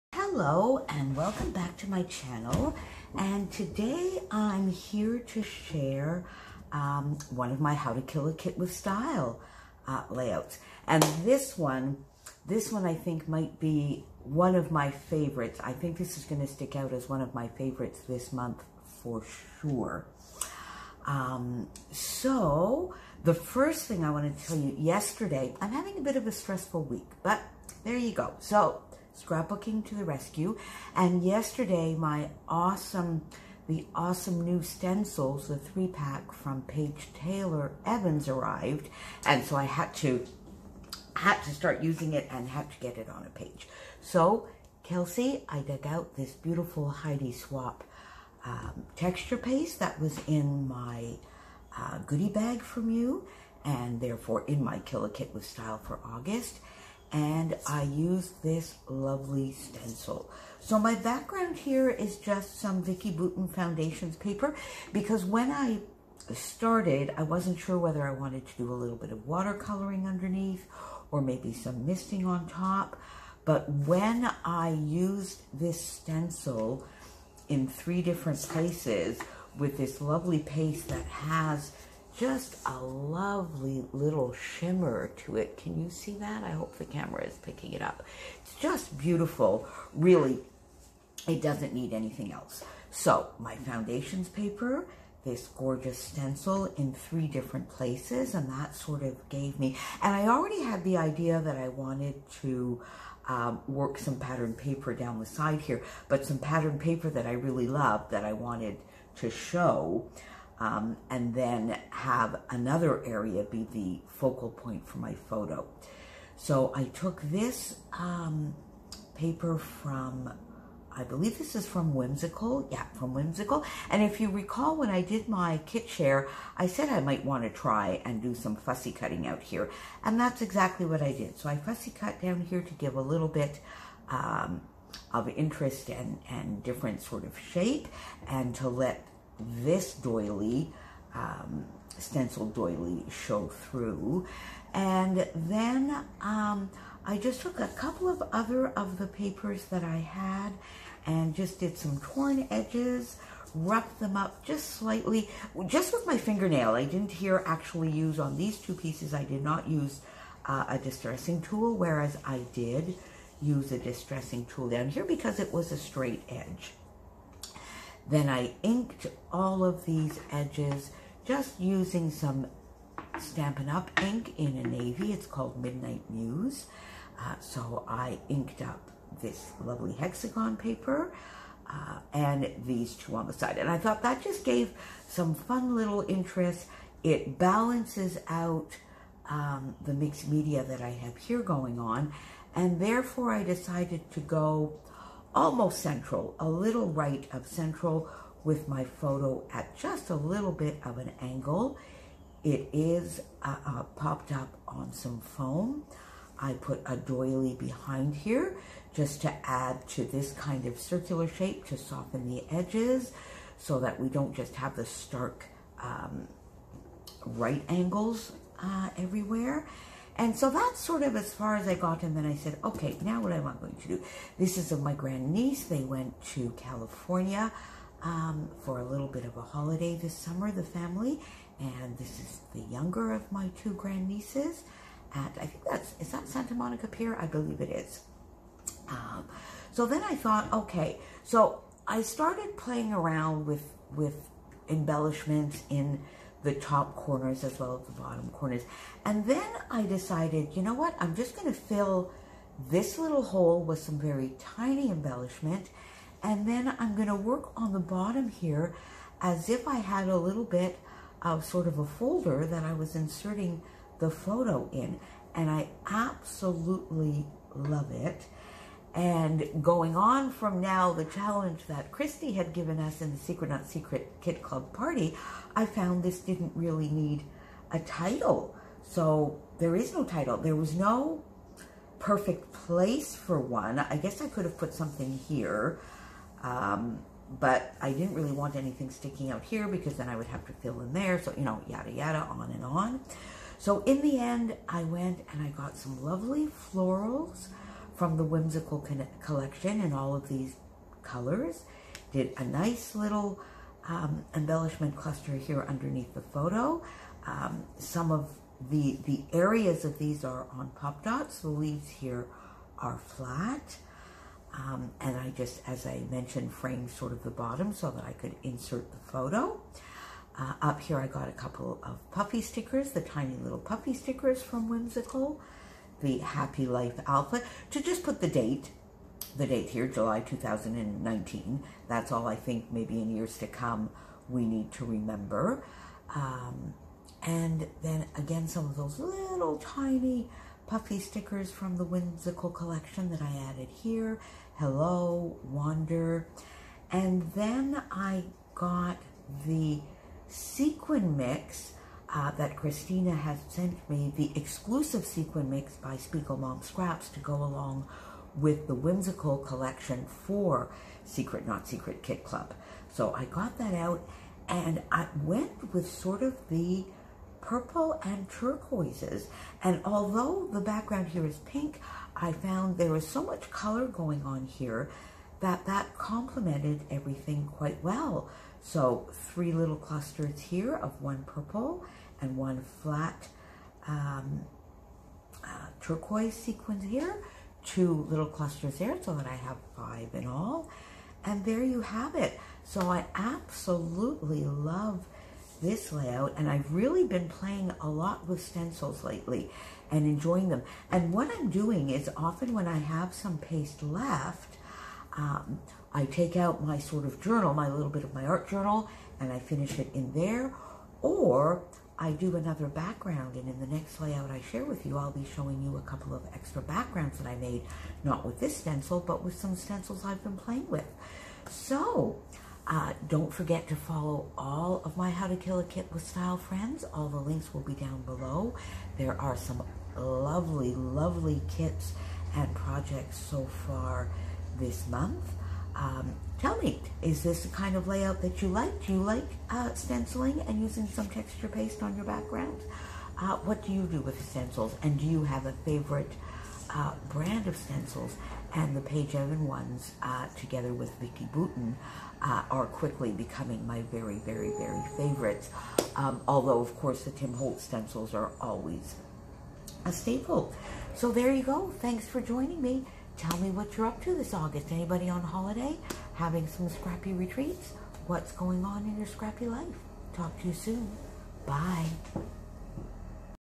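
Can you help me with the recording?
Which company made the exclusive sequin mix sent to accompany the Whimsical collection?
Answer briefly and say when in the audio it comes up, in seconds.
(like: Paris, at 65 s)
Mom Scraps, at 356 s.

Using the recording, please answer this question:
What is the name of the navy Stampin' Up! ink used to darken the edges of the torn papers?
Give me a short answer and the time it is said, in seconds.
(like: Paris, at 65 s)
Midnight Muse, at 175 s.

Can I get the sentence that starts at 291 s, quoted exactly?
So, you know, yada, yada, on and on.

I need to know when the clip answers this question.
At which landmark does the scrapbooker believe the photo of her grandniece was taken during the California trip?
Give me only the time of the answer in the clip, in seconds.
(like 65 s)
236 s.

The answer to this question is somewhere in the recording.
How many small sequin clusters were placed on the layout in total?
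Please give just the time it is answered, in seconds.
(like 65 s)
389 s.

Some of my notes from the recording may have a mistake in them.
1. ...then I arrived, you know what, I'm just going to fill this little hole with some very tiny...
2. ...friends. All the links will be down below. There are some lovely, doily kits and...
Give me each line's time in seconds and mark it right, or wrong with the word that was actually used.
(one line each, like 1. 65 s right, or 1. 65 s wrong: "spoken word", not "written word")
1. 249 s wrong: "decided", not "arrived"
2. 426 s wrong: "lovely", not "doily".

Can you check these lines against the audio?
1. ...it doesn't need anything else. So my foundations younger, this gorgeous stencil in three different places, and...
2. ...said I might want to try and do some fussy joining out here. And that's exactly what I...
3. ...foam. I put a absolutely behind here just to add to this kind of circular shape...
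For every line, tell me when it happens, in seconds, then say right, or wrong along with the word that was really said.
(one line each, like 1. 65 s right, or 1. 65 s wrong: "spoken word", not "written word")
1. 91 s wrong: "paper", not "younger"
2. 126 s wrong: "cutting", not "joining"
3. 205 s wrong: "doily", not "absolutely".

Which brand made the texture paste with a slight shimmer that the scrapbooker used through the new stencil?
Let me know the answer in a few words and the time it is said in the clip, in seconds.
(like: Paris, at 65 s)
Heidi Swapp, at 46 s.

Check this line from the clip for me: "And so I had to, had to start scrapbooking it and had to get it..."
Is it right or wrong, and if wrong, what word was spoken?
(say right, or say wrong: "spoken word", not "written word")
wrong: "using", not "scrapbooking".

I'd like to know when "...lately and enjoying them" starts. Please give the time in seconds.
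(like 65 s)
399 s.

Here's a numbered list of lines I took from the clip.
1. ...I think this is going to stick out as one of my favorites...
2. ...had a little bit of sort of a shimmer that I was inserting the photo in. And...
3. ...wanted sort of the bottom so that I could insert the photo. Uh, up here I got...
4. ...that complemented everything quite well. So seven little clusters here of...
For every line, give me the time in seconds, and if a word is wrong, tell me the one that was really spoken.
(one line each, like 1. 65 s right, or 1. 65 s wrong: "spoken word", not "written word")
1. 15 s right
2. 259 s wrong: "folder", not "shimmer"
3. 316 s wrong: "framed", not "wanted"
4. 375 s wrong: "three", not "seven".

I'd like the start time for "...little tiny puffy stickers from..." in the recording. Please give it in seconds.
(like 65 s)
338 s.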